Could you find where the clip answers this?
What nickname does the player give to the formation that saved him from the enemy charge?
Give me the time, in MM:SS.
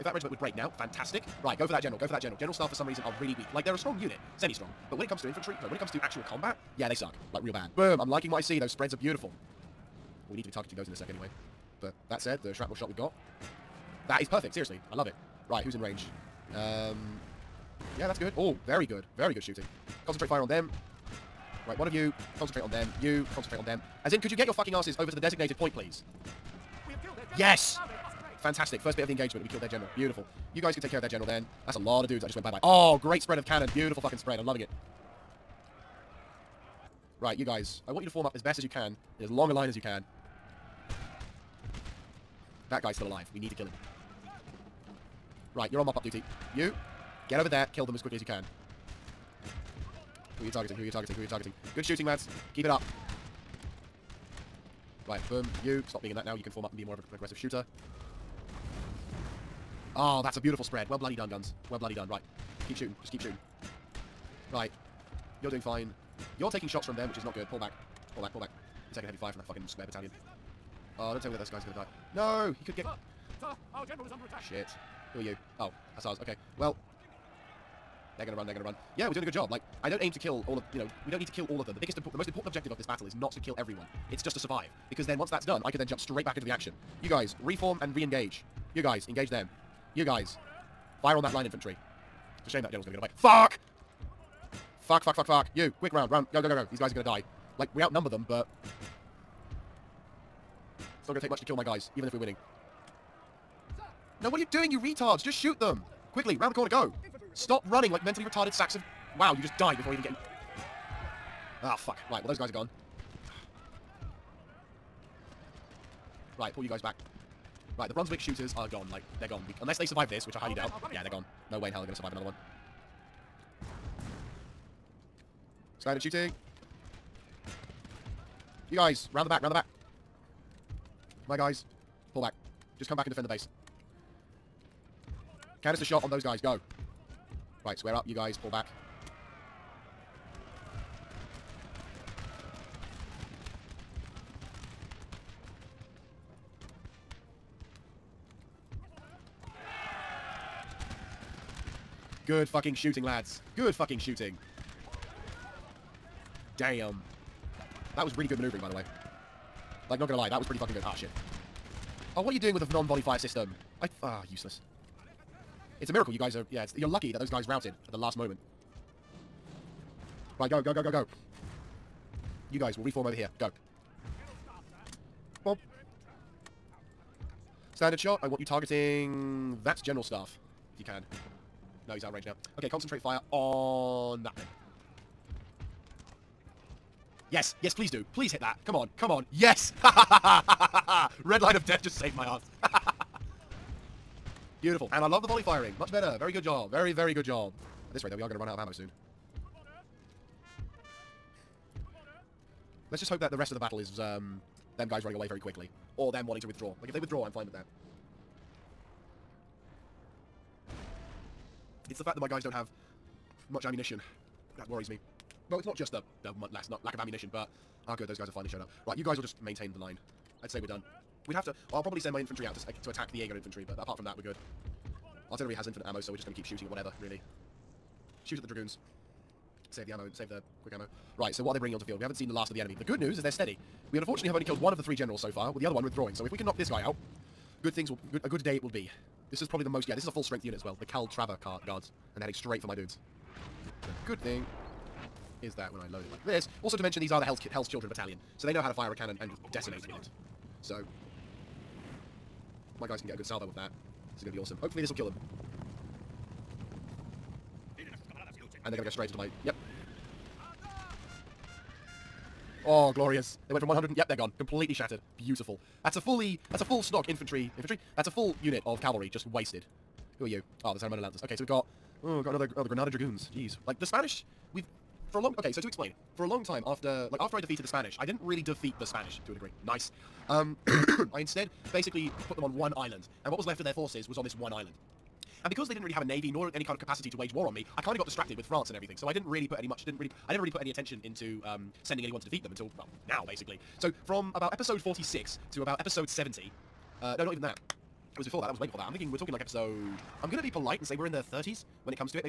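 03:09.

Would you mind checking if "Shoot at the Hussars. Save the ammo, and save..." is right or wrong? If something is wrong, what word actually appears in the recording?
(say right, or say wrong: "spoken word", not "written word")
wrong: "Dragoons", not "Hussars".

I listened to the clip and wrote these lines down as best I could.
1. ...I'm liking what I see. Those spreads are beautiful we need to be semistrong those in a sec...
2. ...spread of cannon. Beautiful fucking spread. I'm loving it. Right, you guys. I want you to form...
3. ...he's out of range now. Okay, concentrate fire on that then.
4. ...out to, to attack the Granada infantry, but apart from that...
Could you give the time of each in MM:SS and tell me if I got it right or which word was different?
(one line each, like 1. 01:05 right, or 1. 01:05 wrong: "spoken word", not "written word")
1. 00:07 wrong: "targeting", not "semistrong"
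2. 00:33 right
3. 03:01 right
4. 03:42 wrong: "Aegon", not "Granada".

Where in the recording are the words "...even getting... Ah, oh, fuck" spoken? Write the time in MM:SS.
01:49.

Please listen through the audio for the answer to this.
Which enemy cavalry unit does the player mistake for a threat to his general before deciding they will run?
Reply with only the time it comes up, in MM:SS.
01:15.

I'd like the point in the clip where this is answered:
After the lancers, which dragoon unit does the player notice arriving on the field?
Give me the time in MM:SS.
04:32.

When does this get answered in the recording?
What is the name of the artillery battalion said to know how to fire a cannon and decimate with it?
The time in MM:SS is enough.
04:07.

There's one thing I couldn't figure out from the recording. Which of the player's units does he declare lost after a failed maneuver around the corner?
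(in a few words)
Brunswick shooters.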